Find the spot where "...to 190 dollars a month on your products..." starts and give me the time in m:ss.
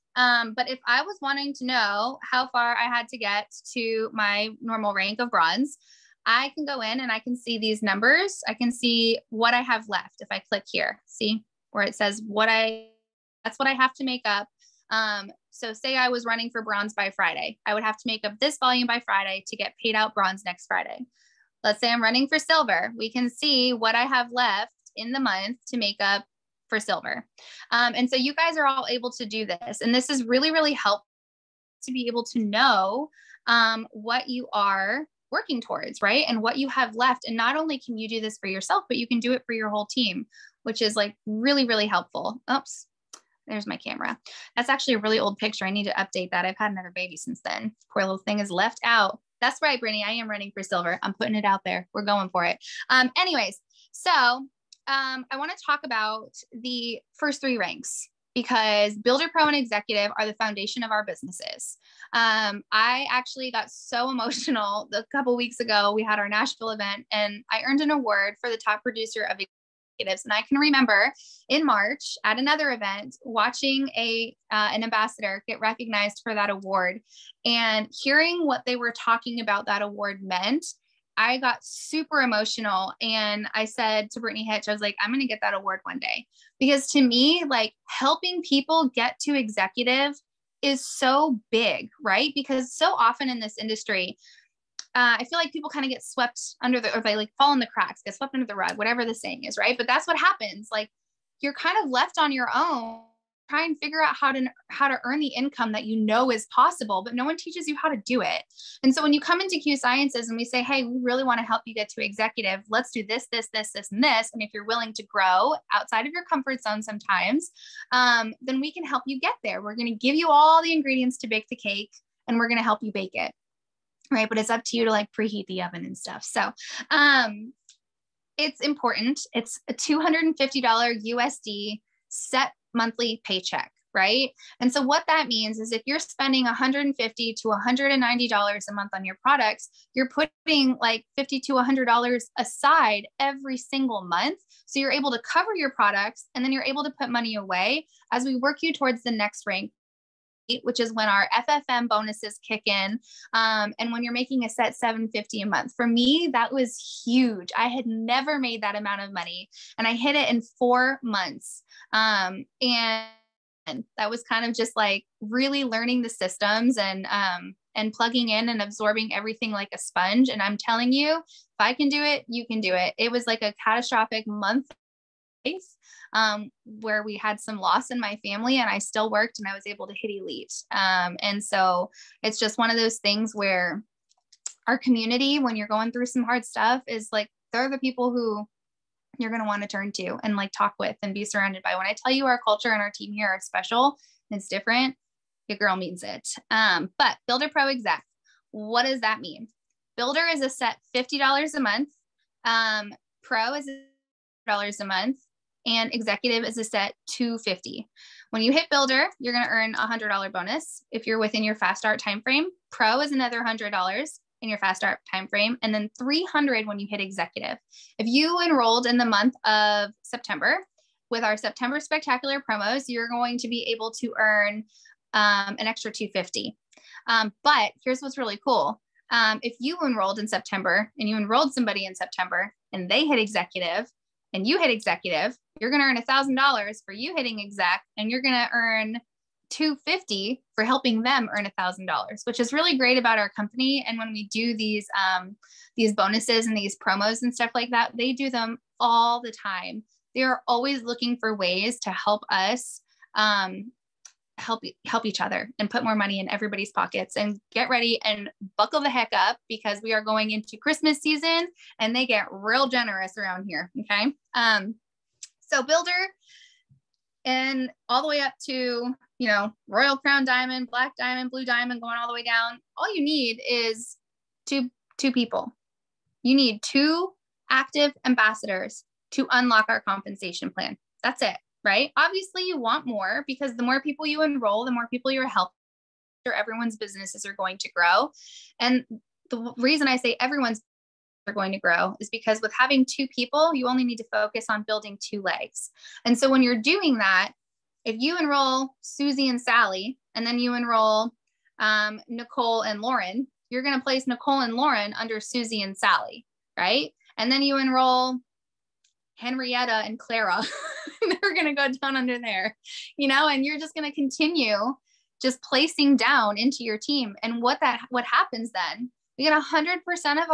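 2:17.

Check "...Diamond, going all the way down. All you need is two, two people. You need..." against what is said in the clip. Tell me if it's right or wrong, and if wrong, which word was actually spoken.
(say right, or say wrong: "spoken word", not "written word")
right.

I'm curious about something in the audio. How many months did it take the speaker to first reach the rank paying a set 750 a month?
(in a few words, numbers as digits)
4.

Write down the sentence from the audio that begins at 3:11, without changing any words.
When I tell you our culture and our team here are special and it's different, your girl means it.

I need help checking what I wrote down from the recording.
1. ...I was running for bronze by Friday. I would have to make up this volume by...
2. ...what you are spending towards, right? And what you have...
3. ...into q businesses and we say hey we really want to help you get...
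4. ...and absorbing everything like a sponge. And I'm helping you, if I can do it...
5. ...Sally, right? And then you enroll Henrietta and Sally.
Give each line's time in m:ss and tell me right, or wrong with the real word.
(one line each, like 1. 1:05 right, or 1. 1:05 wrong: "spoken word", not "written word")
1. 0:15 right
2. 0:33 wrong: "working", not "spending"
3. 1:49 wrong: "sciences", not "businesses"
4. 2:48 wrong: "telling", not "helping"
5. 5:05 wrong: "Clara", not "Sally".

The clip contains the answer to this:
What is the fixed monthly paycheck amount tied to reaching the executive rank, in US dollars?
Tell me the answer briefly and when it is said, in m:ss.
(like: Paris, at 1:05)
$250, at 2:09.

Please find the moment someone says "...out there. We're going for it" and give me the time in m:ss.
0:51.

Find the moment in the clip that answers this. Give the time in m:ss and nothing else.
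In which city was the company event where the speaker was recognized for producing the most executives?
1:06.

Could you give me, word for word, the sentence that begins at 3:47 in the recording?
Um, but here's what's really cool.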